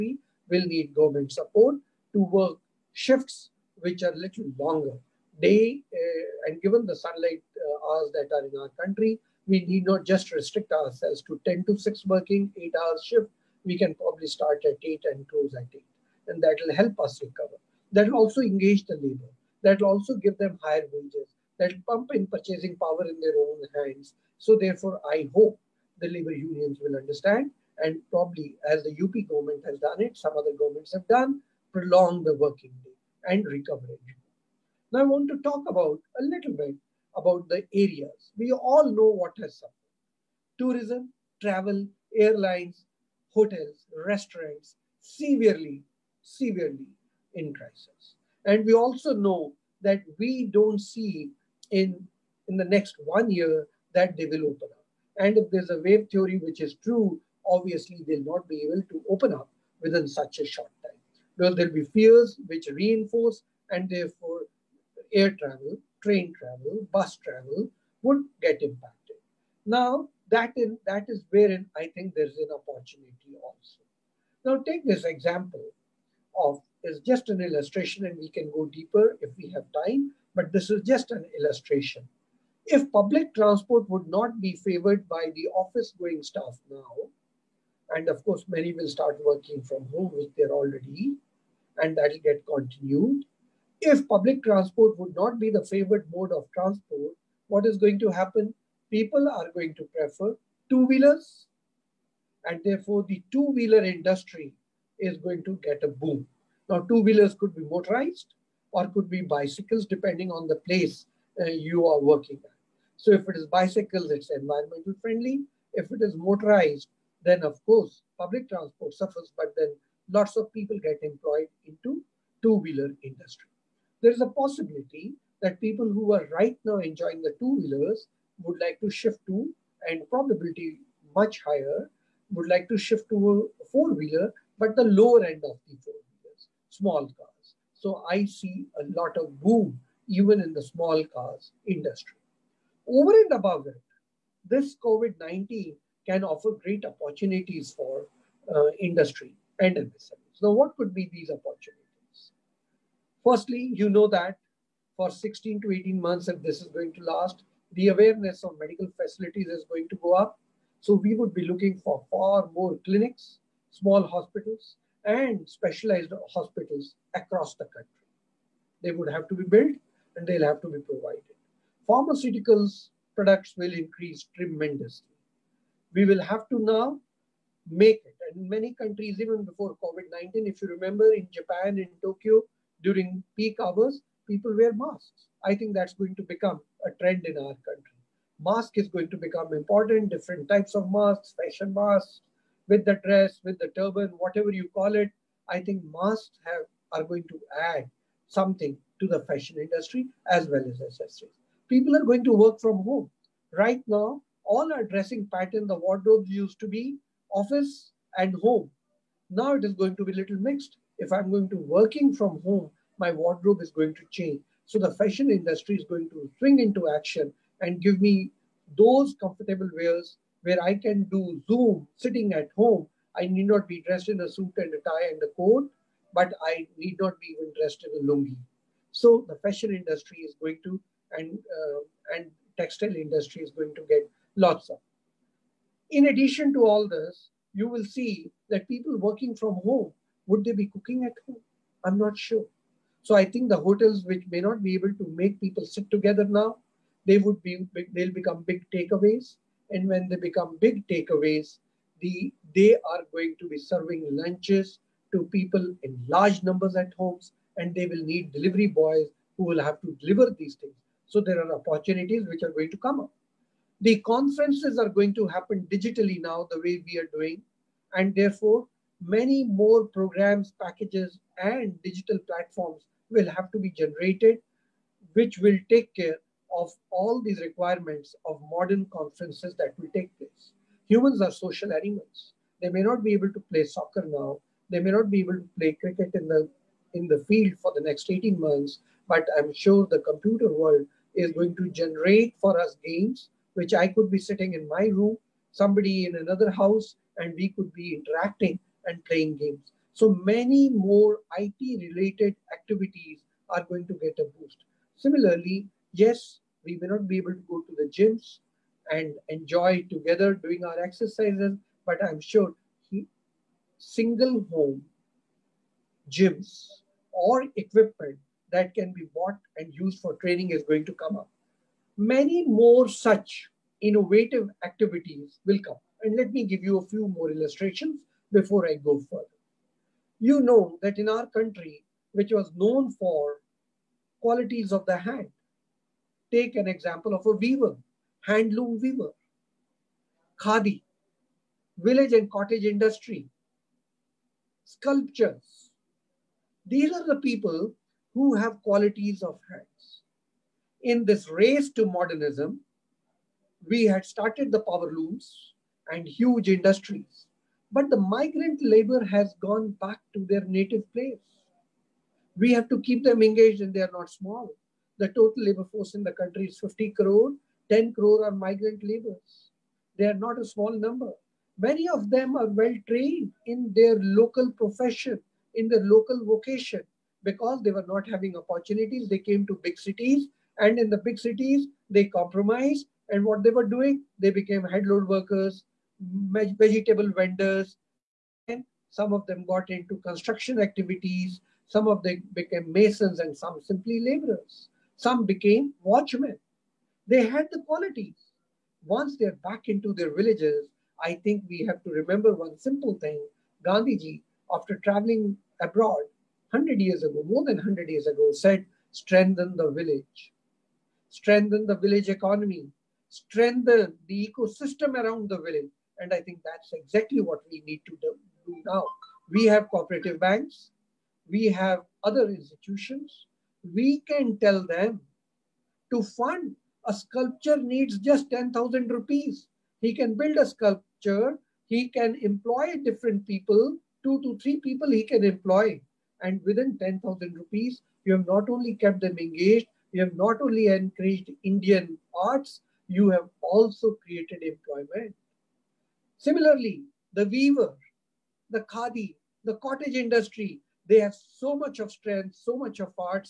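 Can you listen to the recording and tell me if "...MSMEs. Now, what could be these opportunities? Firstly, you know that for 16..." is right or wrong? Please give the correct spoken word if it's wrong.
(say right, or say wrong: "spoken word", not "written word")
right.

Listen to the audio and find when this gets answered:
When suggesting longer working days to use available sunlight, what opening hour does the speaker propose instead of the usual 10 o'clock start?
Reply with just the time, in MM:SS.
00:14.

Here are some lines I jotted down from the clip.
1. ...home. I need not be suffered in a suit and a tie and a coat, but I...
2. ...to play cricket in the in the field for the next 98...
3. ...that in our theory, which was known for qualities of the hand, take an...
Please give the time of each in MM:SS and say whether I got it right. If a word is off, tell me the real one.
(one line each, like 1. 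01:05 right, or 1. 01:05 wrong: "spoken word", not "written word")
1. 03:42 wrong: "dressed", not "suffered"
2. 04:45 wrong: "18", not "98"
3. 05:30 wrong: "country", not "theory".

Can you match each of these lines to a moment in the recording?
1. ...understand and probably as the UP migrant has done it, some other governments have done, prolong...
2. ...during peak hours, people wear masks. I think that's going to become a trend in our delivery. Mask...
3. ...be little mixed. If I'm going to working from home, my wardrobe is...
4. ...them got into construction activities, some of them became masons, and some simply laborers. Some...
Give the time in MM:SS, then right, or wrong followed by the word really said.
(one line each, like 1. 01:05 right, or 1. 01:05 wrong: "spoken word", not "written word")
1. 00:26 wrong: "government", not "migrant"
2. 03:02 wrong: "country", not "delivery"
3. 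03:30 right
4. 06:29 right.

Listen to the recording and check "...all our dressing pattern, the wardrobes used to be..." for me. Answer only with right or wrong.
right.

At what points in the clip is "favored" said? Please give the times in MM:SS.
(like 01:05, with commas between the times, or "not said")
01:24, 01:35.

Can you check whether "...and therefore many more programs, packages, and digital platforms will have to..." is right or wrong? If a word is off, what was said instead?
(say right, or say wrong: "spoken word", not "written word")
right.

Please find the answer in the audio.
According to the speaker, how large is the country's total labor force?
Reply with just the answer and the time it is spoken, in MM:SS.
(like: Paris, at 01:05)
50 crore, at 06:06.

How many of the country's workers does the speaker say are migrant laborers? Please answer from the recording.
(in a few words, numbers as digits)
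10 crore.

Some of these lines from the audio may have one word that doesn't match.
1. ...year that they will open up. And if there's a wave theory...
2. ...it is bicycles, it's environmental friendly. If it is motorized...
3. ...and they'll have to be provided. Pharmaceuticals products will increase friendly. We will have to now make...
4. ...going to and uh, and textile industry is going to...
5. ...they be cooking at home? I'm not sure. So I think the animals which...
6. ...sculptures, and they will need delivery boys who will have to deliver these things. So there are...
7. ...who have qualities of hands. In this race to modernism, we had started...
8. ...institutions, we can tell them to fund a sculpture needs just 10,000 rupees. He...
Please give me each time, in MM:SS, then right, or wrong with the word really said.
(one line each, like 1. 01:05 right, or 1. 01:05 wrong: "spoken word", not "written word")
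1. 00:53 right
2. 01:53 right
3. 02:50 wrong: "tremendously", not "friendly"
4. 03:50 right
5. 04:00 wrong: "hotels", not "animals"
6. 04:16 wrong: "homes", not "sculptures"
7. 05:48 right
8. 07:02 right.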